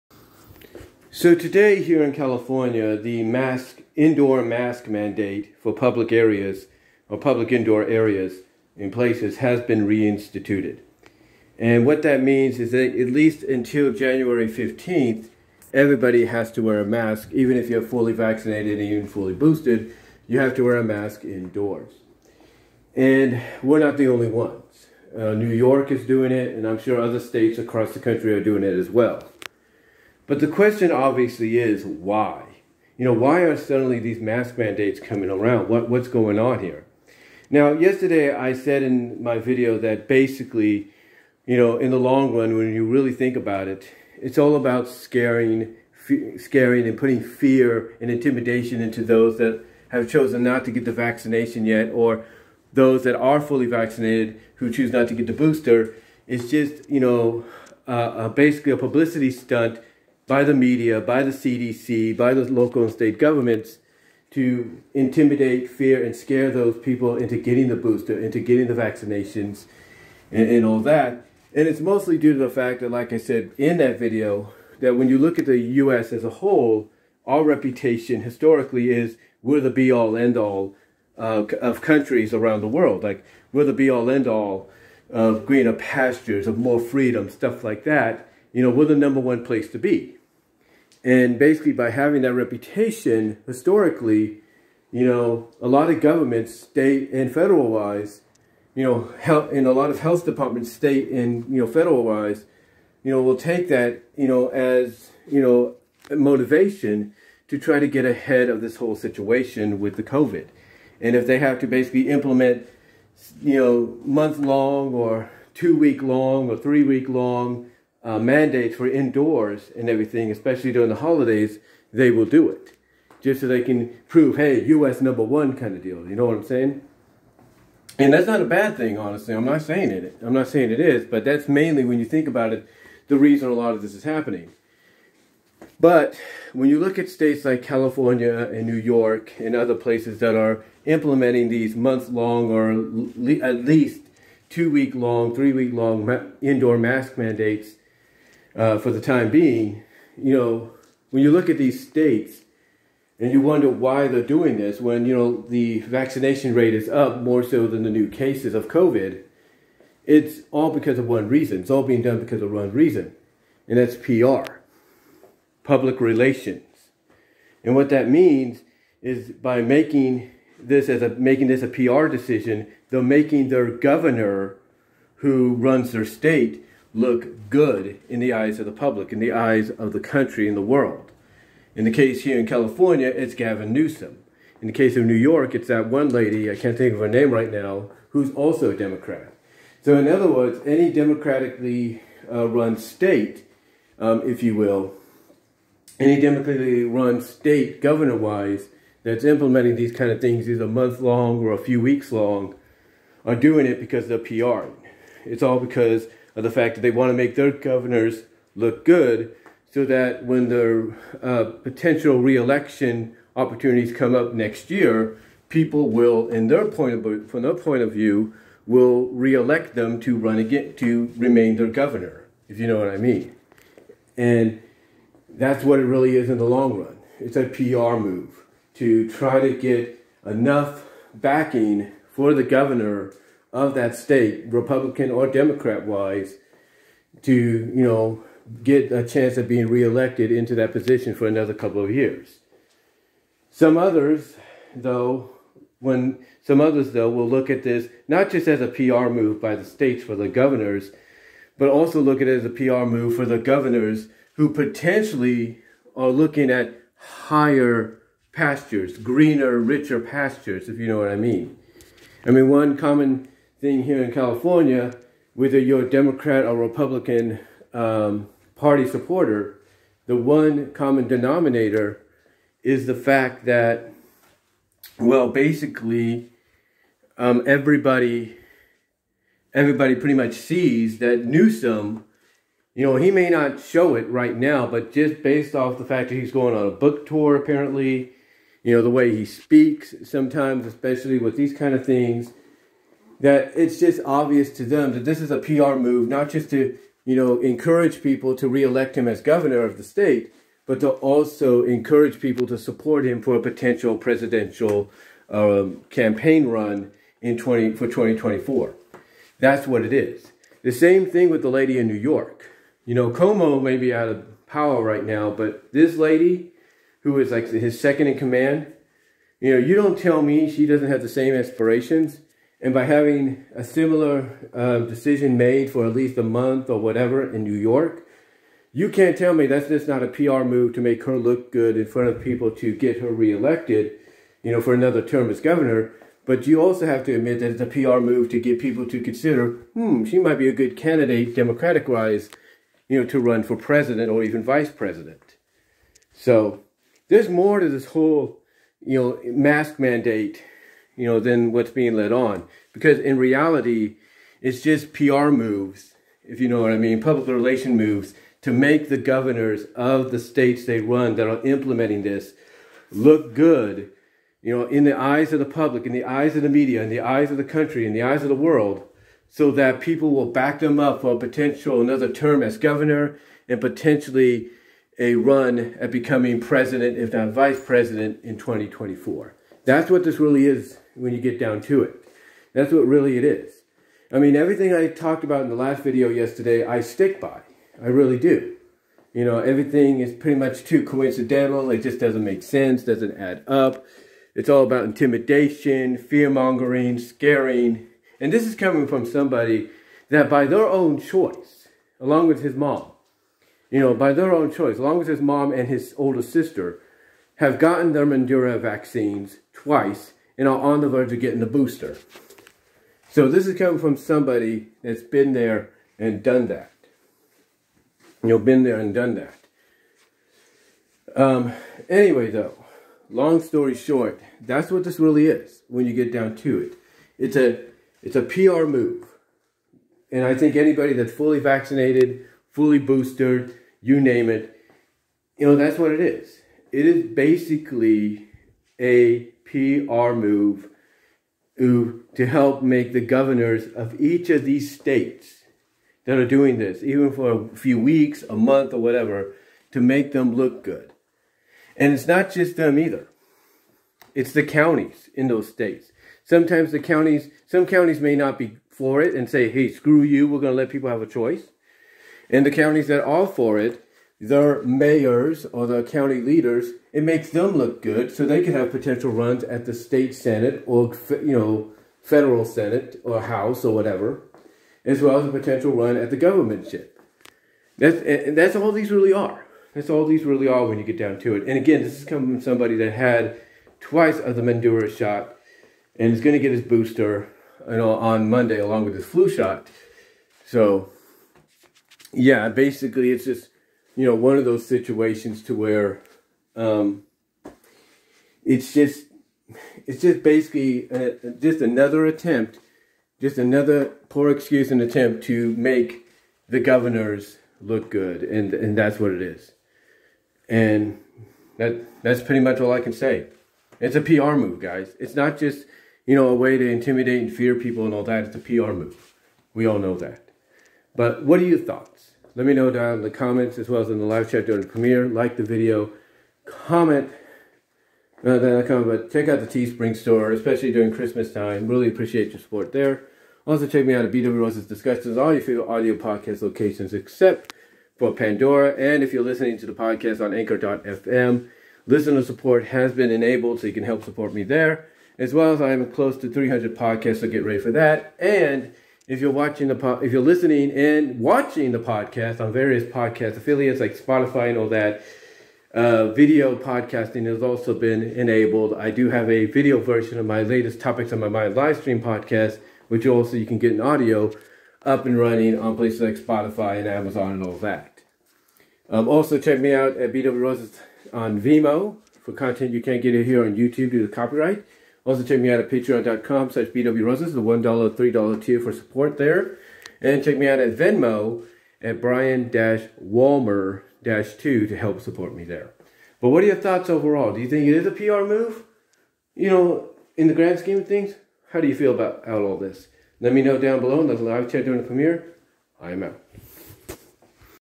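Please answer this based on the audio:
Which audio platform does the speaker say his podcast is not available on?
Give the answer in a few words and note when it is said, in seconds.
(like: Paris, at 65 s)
Pandora, at 538 s.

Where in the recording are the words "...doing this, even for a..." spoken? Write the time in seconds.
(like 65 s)
446 s.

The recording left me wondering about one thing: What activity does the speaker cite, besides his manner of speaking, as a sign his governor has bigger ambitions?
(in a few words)
book tour.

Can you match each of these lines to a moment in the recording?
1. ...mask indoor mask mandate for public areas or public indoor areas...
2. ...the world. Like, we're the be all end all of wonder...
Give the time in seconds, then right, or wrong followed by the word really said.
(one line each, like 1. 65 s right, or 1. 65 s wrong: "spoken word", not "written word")
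1. 3 s right
2. 82 s wrong: "greener", not "wonder".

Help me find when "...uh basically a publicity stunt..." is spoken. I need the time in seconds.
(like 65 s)
57 s.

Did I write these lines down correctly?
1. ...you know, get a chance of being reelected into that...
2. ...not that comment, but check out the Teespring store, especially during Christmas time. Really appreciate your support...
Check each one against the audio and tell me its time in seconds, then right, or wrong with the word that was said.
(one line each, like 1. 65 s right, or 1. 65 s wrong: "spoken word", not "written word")
1. 237 s right
2. 528 s right.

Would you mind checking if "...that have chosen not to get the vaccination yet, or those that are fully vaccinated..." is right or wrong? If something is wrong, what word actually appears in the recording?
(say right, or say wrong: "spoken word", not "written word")
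right.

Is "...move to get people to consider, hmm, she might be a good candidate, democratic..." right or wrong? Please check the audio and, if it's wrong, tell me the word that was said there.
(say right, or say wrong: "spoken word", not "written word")
right.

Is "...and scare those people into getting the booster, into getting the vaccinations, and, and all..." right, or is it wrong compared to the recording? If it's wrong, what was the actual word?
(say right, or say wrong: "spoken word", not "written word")
right.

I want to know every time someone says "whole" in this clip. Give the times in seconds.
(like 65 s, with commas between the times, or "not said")
76 s, 108 s, 347 s.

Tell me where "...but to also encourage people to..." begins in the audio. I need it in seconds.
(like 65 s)
300 s.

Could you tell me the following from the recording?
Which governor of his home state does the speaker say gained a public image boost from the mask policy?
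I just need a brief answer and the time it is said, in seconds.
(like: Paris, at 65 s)
Gavin Newsom, at 183 s.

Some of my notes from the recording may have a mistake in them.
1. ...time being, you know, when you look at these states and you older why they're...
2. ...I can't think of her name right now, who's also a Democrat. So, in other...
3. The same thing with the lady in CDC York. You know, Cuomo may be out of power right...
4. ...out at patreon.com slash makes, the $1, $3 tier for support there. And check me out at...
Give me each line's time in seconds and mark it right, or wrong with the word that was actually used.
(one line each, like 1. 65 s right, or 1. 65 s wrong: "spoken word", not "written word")
1. 149 s wrong: "wonder", not "older"
2. 186 s right
3. 310 s wrong: "New", not "CDC"
4. 575 s wrong: "bwroses", not "makes".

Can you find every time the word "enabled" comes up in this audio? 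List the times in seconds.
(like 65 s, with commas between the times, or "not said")
543 s, 558 s.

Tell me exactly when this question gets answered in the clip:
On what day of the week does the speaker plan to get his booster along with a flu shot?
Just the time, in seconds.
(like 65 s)
488 s.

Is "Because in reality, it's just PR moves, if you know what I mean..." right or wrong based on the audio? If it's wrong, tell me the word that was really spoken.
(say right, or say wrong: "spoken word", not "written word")
right.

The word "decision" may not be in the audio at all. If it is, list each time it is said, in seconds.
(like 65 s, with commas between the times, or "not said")
172 s, 324 s.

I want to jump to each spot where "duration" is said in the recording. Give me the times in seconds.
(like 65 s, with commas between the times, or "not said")
not said.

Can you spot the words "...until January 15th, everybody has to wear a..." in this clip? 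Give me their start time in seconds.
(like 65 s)
13 s.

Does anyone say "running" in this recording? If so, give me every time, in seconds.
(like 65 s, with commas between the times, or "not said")
565 s.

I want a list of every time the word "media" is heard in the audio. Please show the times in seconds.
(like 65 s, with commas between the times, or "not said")
60 s, 366 s.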